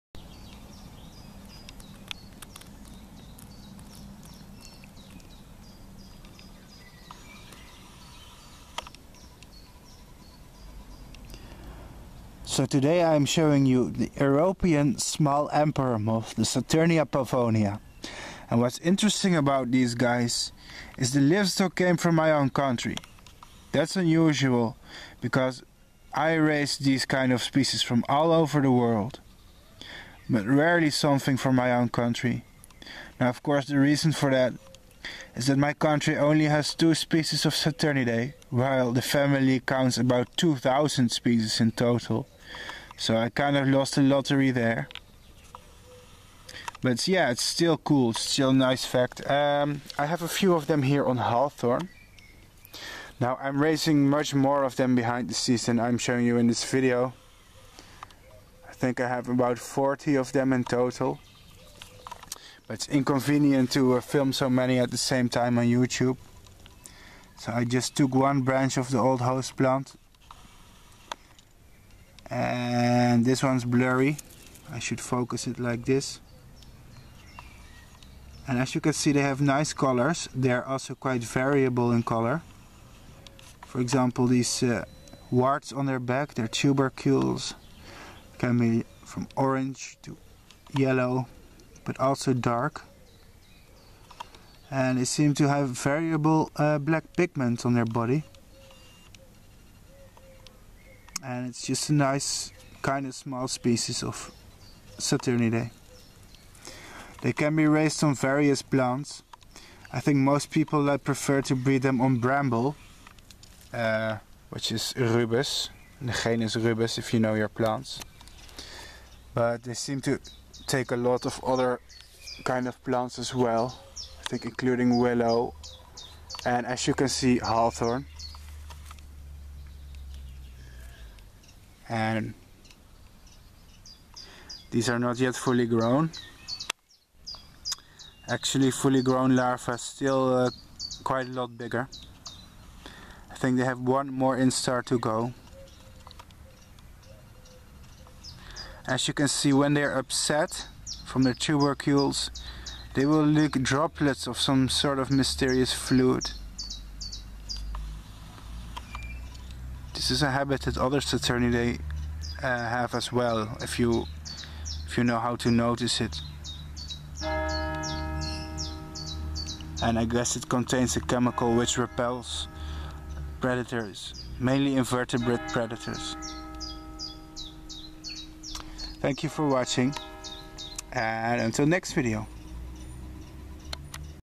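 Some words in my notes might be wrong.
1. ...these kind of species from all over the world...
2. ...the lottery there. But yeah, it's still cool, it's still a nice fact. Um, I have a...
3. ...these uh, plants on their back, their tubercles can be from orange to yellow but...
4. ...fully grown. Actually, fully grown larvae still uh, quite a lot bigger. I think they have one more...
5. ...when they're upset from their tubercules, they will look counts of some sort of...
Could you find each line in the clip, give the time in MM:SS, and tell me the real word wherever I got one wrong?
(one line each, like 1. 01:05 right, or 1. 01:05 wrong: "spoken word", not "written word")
1. 00:26 right
2. 00:43 right
3. 01:24 wrong: "warts", not "plants"
4. 02:15 right
5. 02:29 wrong: "droplets", not "counts".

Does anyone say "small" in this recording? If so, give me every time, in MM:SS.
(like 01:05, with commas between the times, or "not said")
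00:14, 01:43.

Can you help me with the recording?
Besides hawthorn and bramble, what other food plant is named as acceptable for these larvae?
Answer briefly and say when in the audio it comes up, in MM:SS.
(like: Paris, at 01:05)
Willow, at 02:04.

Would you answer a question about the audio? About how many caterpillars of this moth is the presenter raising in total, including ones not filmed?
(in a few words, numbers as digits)
40.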